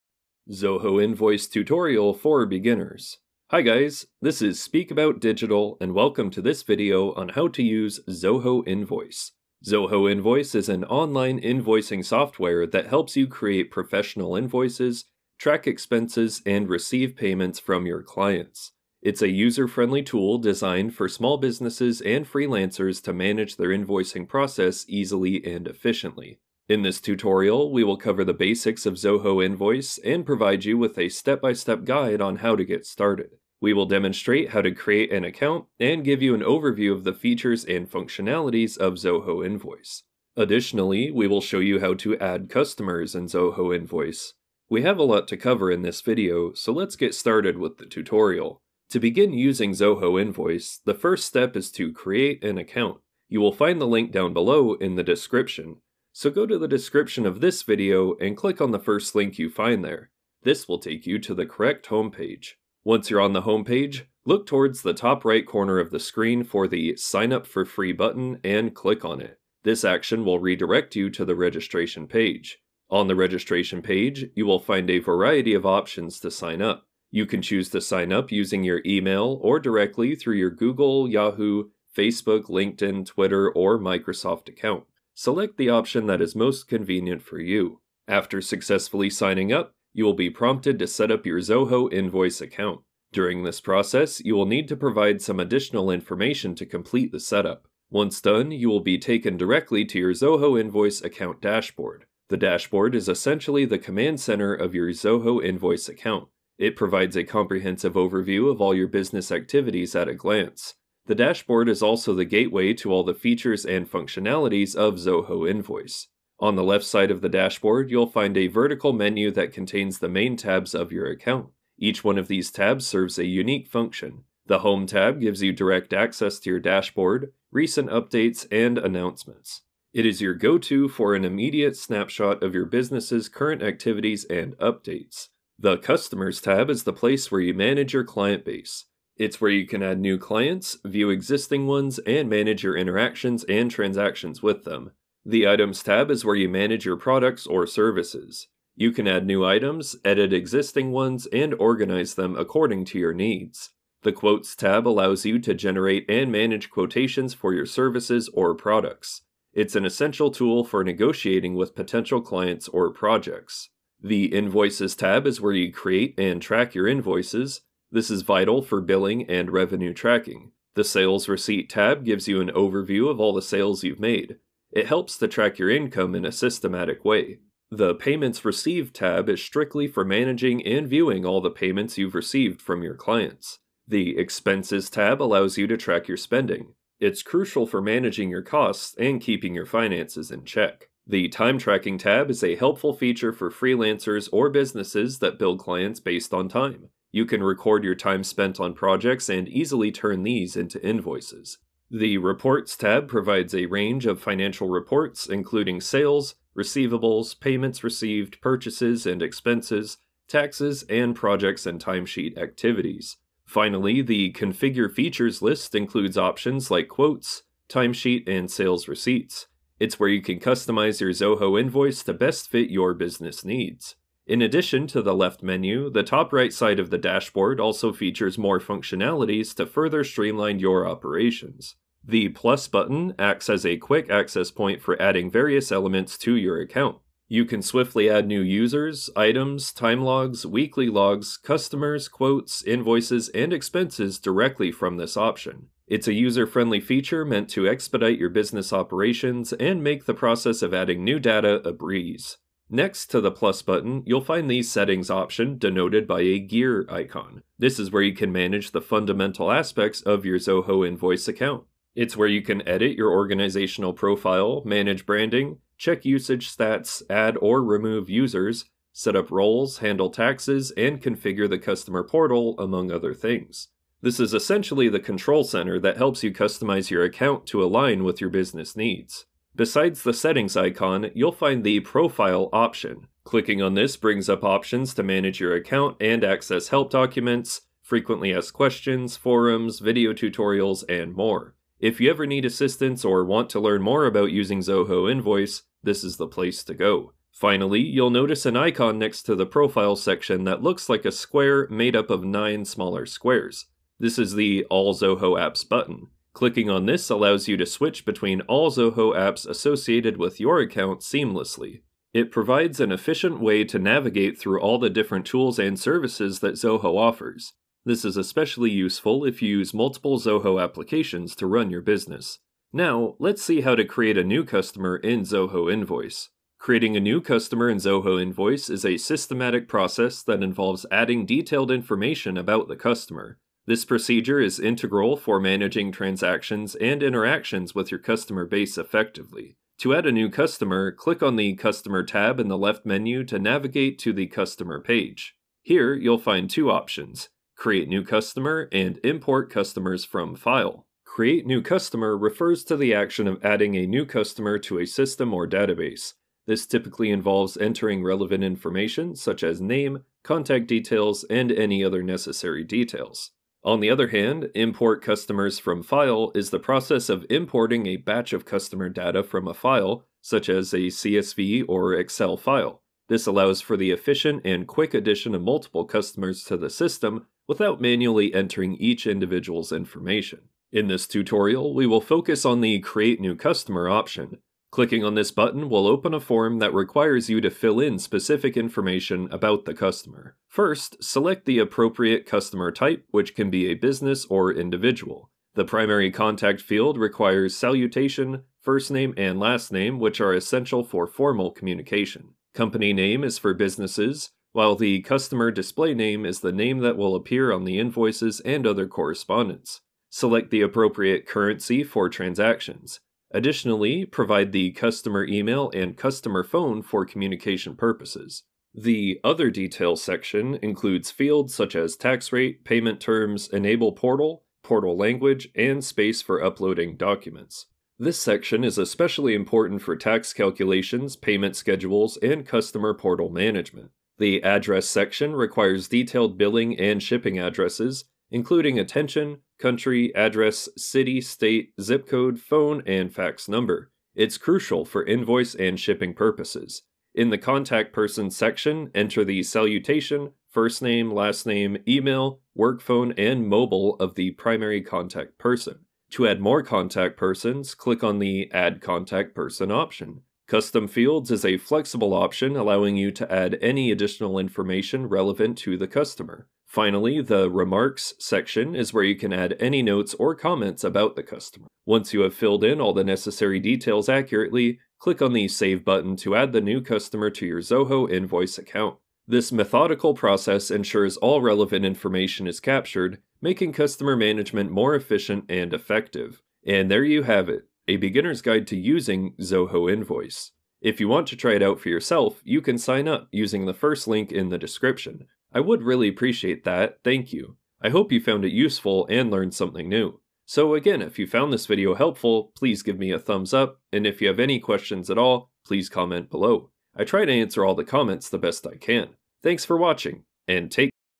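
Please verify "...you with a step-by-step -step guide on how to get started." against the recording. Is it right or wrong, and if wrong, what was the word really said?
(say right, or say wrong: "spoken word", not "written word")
right.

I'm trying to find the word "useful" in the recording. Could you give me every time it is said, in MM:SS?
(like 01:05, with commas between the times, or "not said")
05:18, 08:18.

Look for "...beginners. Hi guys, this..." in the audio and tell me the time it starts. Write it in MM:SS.
00:02.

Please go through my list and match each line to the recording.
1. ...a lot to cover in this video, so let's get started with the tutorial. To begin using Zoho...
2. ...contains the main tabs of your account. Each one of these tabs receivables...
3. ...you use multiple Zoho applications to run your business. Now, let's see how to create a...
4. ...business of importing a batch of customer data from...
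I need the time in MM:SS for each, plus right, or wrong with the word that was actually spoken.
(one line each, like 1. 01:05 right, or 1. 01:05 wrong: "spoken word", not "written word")
1. 00:44 right
2. 01:59 wrong: "serves", not "receivables"
3. 05:19 right
4. 06:06 wrong: "process", not "business".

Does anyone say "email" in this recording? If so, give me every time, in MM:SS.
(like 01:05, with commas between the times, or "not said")
01:18, 06:55, 07:31.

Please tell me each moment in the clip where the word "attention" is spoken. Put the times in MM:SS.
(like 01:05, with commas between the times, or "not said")
07:18.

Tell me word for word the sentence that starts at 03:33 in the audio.
Finally, the Configure Features list includes options like quotes, timesheet, and sales receipts.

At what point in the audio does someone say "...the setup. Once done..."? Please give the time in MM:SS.
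01:37.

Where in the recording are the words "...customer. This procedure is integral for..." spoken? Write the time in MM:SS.
05:32.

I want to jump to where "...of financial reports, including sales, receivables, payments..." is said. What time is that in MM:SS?
03:24.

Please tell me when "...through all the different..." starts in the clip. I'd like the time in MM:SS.
05:14.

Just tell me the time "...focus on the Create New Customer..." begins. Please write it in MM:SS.
06:22.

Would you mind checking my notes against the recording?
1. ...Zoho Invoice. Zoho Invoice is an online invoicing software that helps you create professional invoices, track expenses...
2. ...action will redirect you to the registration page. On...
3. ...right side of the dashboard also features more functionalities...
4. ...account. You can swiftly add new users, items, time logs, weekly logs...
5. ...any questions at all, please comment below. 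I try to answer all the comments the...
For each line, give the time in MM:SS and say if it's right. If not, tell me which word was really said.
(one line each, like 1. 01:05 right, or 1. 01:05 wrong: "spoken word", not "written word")
1. 00:08 right
2. 01:09 right
3. 03:46 right
4. 03:56 right
5. 08:24 right.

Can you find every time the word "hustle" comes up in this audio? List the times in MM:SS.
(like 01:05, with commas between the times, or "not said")
not said.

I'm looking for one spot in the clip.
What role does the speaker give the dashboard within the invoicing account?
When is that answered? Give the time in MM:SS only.
01:43.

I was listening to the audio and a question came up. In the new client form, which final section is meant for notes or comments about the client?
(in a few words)
Remarks.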